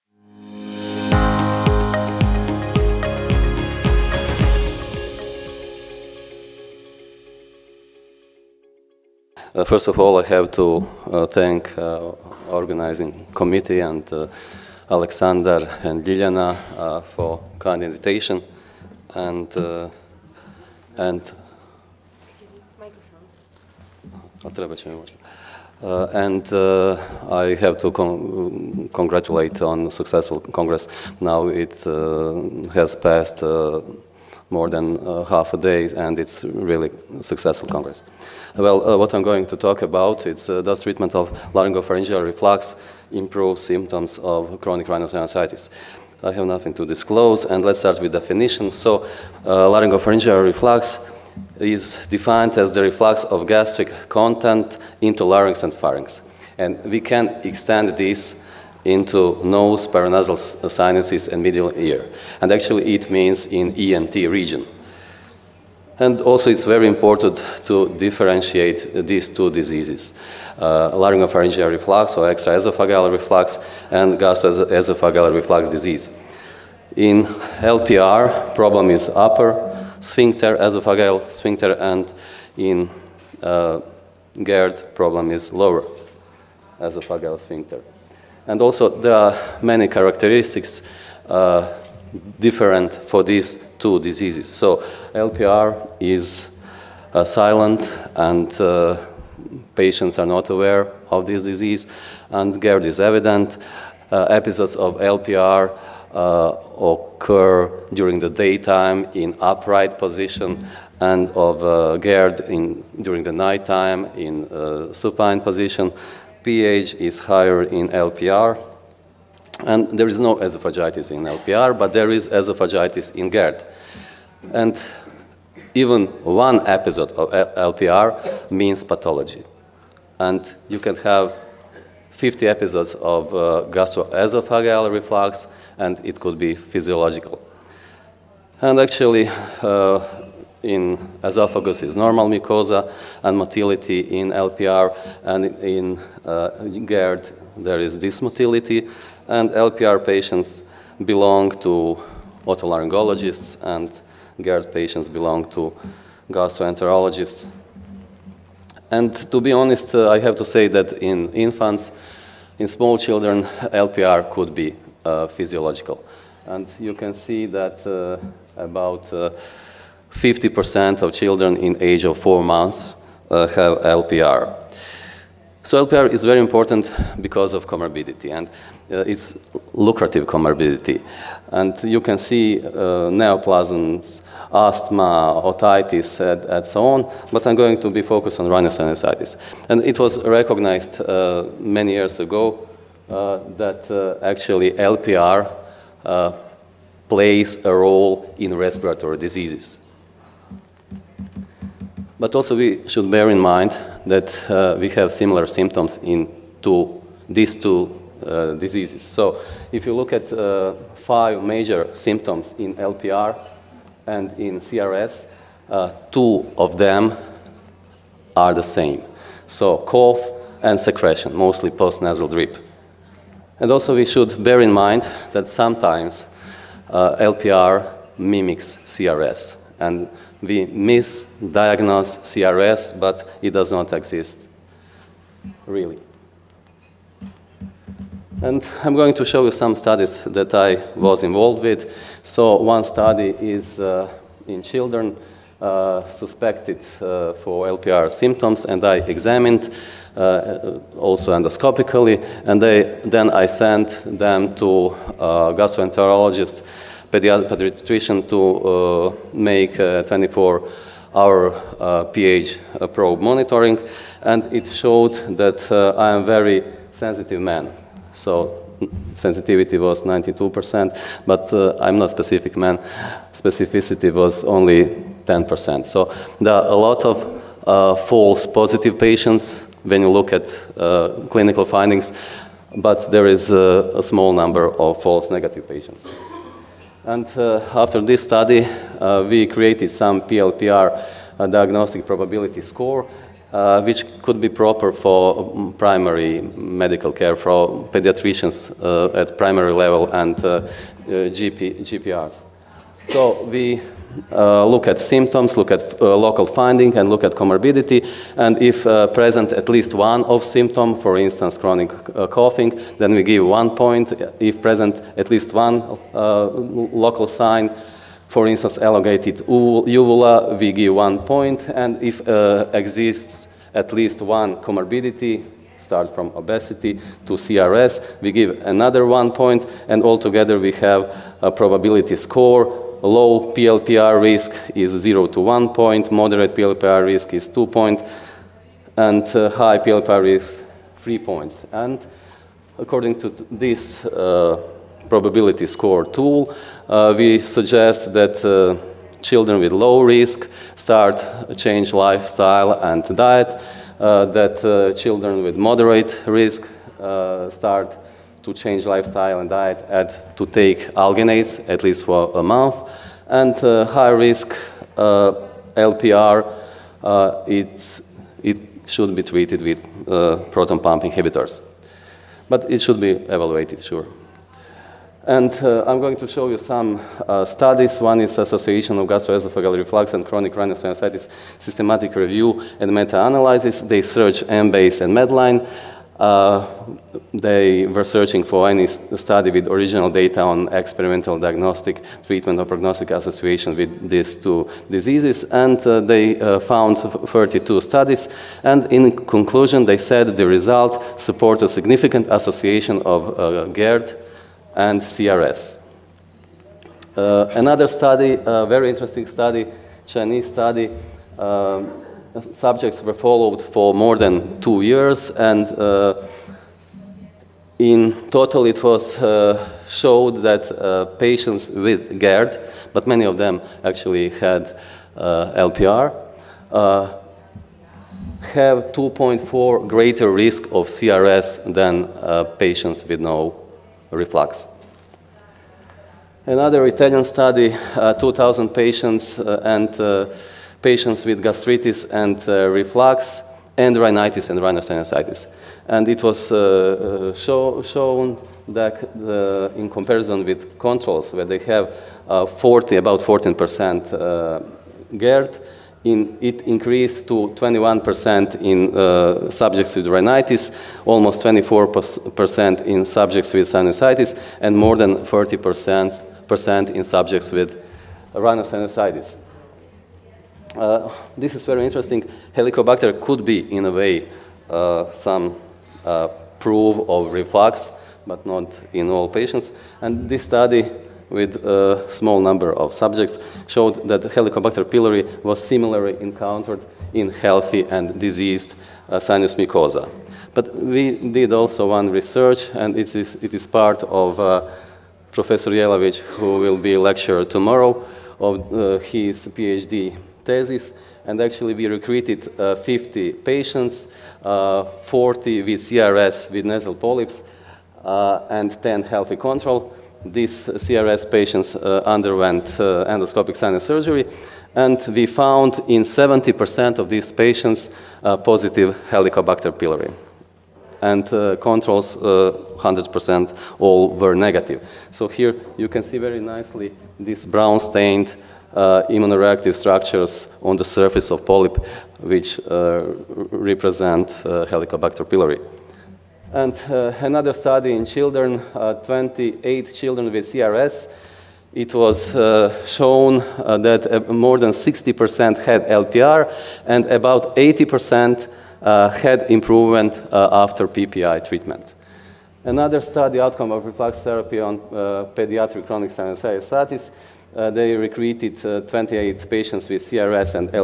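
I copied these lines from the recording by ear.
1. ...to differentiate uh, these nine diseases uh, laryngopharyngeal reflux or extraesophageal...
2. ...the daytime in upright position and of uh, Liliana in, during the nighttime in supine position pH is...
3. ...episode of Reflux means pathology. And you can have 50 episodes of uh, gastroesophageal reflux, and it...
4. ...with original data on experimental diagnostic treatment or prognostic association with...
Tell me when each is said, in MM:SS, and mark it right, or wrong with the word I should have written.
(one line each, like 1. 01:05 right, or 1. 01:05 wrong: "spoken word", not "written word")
1. 01:07 wrong: "two", not "nine"
2. 01:48 wrong: "GERD", not "Liliana"
3. 02:06 wrong: "LPR", not "Reflux"
4. 06:29 right.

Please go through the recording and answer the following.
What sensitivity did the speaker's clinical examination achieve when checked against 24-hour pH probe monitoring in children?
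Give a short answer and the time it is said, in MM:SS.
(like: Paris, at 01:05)
92%, at 04:30.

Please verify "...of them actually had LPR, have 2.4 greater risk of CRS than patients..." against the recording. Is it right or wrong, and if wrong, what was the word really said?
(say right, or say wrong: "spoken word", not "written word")
right.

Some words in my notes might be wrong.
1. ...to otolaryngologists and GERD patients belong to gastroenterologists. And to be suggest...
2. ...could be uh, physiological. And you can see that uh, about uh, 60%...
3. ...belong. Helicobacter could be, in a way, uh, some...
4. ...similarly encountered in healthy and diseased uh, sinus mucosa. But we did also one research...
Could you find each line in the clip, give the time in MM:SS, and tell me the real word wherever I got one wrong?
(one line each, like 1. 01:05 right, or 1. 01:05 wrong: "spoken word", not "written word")
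1. 02:31 wrong: "honest", not "suggest"
2. 02:44 wrong: "50", not "60"
3. 07:51 wrong: "interesting", not "belong"
4. 08:05 right.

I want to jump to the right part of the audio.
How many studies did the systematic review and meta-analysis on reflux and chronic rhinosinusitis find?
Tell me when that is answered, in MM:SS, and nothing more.
06:36.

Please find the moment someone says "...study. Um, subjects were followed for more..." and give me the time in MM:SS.
06:50.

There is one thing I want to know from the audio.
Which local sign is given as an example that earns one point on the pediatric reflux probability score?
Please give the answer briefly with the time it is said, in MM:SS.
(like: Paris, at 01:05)
Elongated uvula, at 05:18.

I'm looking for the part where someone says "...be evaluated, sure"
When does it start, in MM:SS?
06:12.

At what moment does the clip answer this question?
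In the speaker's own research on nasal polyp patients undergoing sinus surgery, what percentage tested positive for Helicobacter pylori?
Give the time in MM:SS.
08:36.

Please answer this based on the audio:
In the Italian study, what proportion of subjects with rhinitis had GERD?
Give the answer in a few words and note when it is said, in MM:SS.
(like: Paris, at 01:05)
21%, at 07:37.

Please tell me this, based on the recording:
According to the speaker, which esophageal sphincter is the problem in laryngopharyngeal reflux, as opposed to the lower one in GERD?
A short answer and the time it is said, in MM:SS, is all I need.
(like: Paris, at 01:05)
Upper sphincter, at 01:19.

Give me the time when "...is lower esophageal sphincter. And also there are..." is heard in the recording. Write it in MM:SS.
01:25.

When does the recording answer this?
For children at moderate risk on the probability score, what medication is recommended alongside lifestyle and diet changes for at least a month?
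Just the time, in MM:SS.
06:00.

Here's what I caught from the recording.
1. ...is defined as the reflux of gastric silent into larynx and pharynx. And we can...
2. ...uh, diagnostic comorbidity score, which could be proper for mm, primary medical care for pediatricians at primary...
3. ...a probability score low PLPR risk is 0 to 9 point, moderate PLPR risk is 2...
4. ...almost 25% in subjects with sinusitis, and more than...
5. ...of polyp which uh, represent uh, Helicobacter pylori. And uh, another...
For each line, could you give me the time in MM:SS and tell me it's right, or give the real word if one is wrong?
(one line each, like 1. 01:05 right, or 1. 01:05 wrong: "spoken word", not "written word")
1. 00:51 wrong: "content", not "silent"
2. 04:51 wrong: "probability", not "comorbidity"
3. 05:31 wrong: "1", not "9"
4. 07:41 wrong: "24", not "25"
5. 08:51 right.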